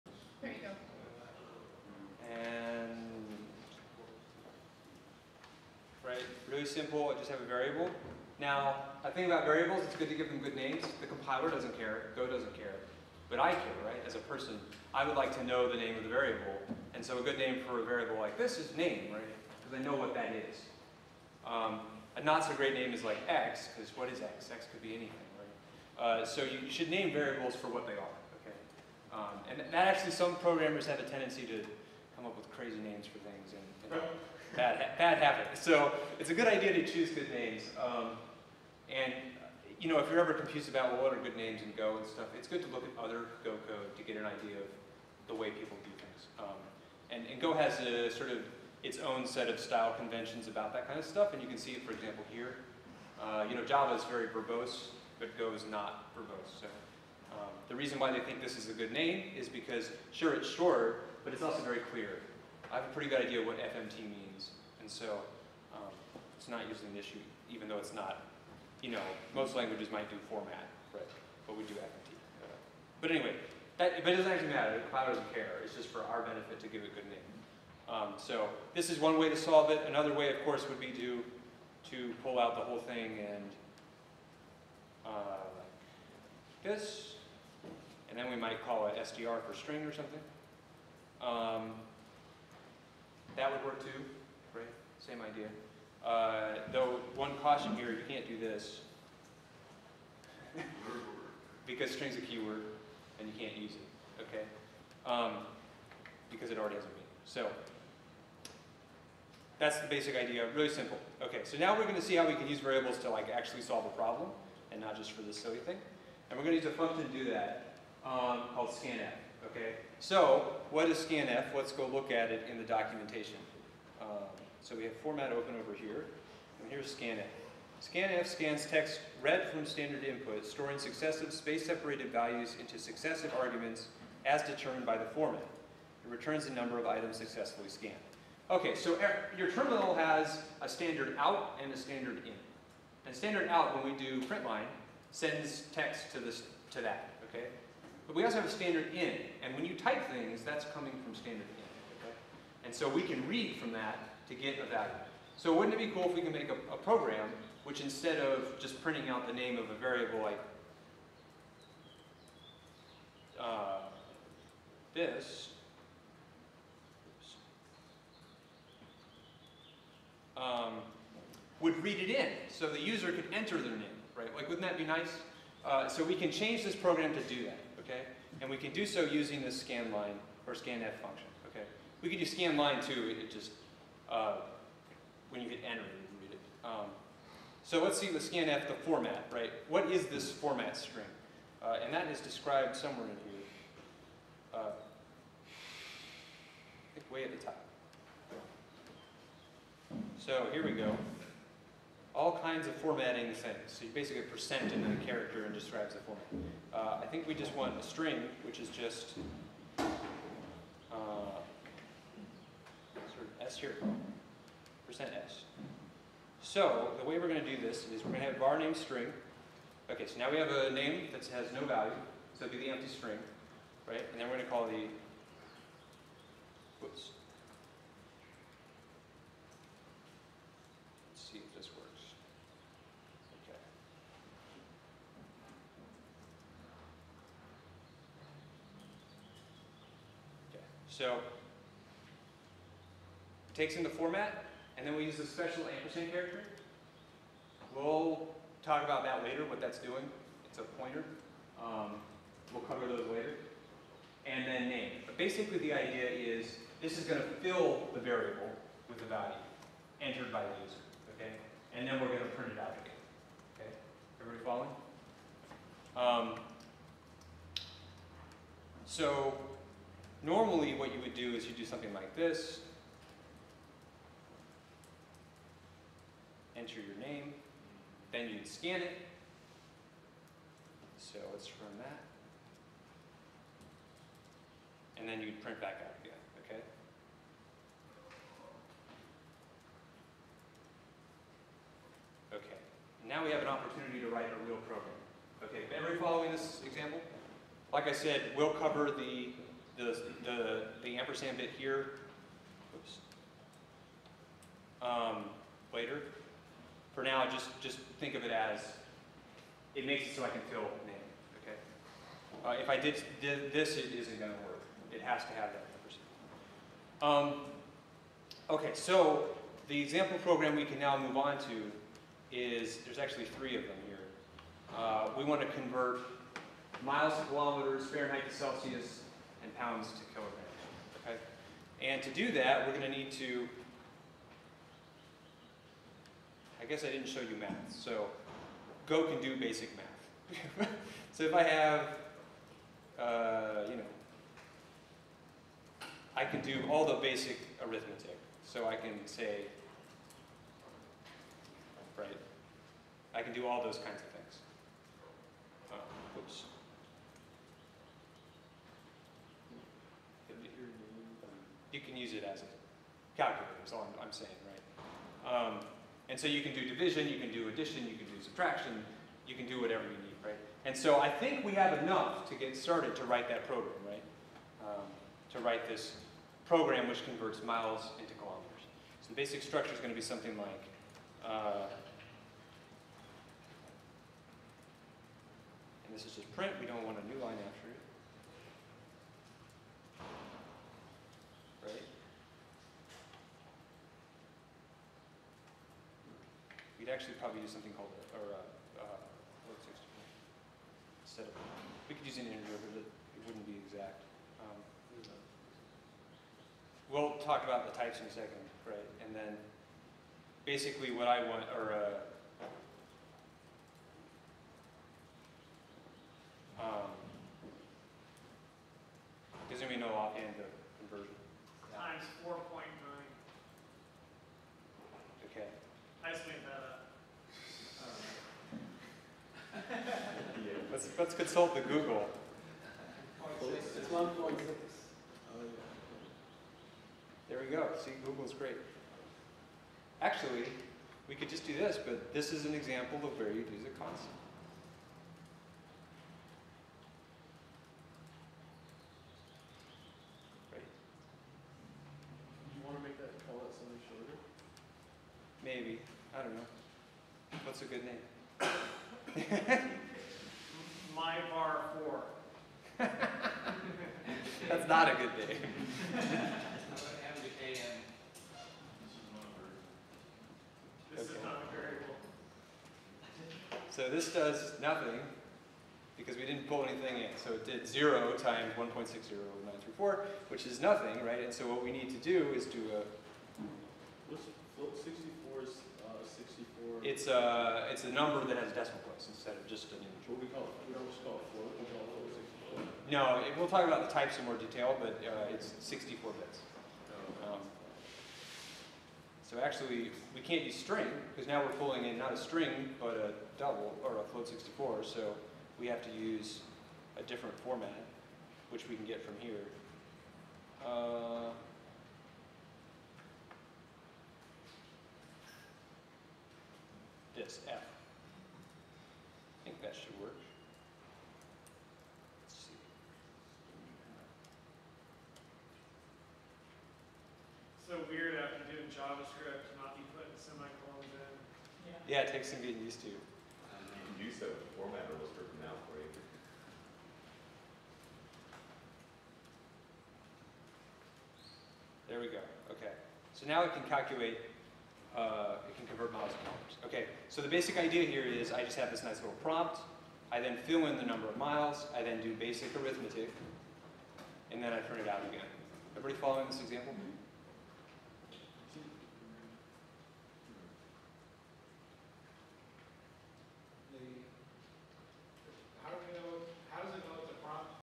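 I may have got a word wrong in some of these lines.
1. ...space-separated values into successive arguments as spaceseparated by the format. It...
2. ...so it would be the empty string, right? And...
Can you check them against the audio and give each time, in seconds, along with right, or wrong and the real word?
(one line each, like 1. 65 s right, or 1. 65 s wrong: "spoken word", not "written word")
1. 131 s wrong: "determined", not "spaceseparated"
2. 222 s right.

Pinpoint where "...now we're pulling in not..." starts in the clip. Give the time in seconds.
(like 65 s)
501 s.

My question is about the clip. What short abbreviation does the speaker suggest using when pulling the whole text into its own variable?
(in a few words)
STR.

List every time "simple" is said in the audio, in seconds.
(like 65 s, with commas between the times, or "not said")
6 s, 110 s.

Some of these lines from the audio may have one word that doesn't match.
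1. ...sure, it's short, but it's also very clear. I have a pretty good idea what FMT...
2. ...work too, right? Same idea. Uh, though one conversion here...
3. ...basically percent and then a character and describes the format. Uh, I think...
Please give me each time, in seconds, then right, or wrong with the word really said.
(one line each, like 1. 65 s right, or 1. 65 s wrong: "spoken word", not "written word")
1. 60 s right
2. 93 s wrong: "caution", not "conversion"
3. 203 s right.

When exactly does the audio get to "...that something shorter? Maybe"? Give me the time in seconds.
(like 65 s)
452 s.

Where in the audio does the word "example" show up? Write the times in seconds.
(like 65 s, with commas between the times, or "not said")
51 s, 296 s, 319 s, 442 s, 556 s.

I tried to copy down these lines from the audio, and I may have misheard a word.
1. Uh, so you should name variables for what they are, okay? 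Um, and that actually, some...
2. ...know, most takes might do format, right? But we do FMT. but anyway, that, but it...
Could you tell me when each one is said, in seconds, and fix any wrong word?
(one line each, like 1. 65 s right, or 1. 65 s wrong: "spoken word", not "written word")
1. 26 s right
2. 68 s wrong: "languages", not "takes".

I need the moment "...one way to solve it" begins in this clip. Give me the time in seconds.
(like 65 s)
79 s.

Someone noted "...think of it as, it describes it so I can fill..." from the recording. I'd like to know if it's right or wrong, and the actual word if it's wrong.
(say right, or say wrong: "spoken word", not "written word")
wrong: "makes", not "describes".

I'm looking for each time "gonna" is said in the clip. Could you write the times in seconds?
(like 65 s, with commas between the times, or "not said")
111 s, 116 s, 314 s.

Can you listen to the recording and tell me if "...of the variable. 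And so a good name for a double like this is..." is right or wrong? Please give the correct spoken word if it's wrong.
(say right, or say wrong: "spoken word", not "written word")
wrong: "variable", not "double".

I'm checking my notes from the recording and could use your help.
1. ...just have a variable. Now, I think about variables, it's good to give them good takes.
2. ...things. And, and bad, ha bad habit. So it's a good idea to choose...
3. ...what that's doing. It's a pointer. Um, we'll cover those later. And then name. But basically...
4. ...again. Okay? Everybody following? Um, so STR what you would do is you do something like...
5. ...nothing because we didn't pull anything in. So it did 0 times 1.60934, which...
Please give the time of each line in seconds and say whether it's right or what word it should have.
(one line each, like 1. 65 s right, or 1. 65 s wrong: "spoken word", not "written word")
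1. 7 s wrong: "names", not "takes"
2. 33 s right
3. 249 s right
4. 262 s wrong: "Normally", not "STR"
5. 474 s right.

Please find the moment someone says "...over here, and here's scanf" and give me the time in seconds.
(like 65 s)
125 s.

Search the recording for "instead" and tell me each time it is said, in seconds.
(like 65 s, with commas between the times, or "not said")
157 s, 401 s, 489 s.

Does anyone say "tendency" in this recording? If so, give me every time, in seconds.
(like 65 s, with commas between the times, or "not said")
31 s.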